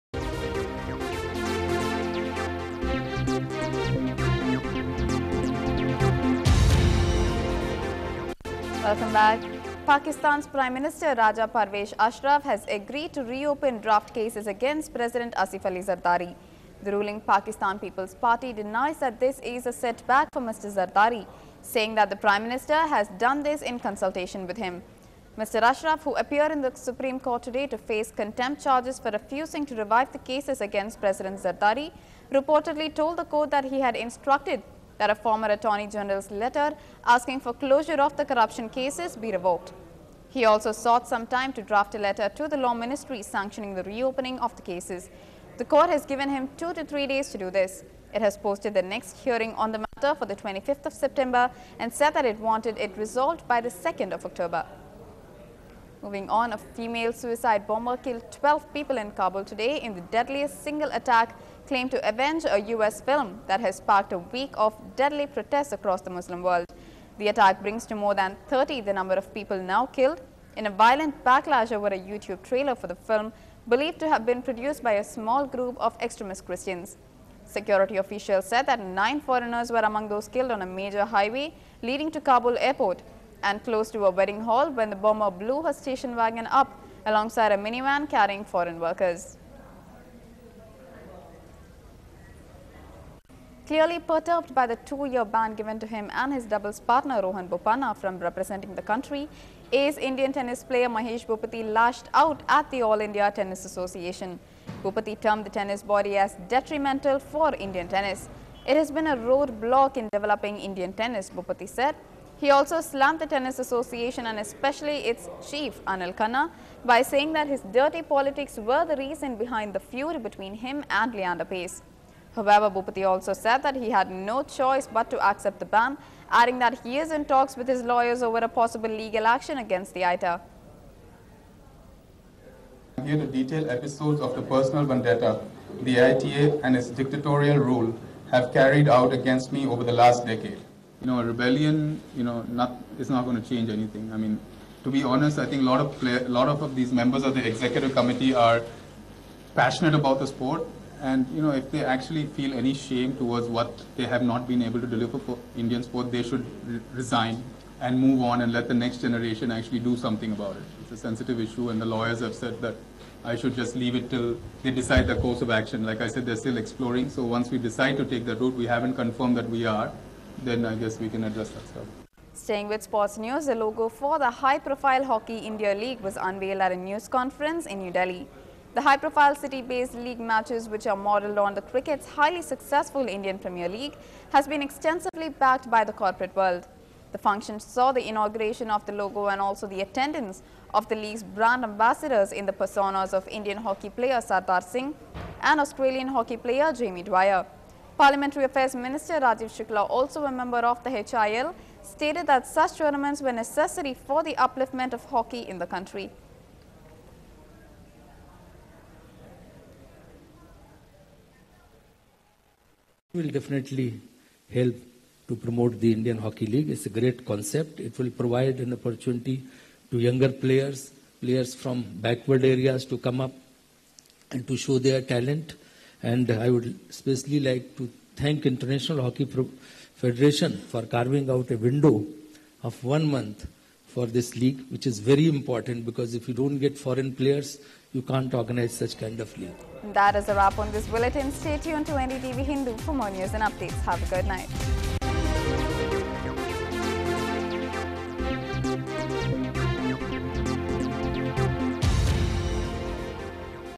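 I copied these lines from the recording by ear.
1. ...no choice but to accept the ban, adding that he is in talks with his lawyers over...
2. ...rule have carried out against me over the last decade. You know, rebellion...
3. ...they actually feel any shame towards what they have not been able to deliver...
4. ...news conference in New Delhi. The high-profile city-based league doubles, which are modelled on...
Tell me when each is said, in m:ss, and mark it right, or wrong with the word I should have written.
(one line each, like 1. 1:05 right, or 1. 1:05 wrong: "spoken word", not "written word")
1. 2:04 right
2. 2:17 right
3. 2:31 right
4. 2:56 wrong: "matches", not "doubles".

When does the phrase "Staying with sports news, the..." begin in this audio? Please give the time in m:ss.
2:52.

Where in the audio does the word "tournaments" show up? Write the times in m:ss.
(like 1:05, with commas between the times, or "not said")
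3:22.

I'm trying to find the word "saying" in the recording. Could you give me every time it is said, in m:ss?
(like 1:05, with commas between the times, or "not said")
0:21, 1:57.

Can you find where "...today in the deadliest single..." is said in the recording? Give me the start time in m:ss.
0:59.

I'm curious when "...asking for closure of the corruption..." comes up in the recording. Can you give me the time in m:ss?
0:37.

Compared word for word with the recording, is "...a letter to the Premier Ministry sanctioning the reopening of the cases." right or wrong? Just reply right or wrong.
wrong.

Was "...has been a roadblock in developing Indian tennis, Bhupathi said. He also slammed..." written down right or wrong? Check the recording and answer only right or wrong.
right.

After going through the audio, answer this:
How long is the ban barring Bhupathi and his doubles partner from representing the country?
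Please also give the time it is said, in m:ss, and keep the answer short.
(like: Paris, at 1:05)
2 years, at 1:34.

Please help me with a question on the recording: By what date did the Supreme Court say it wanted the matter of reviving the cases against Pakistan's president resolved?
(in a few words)
2nd of October.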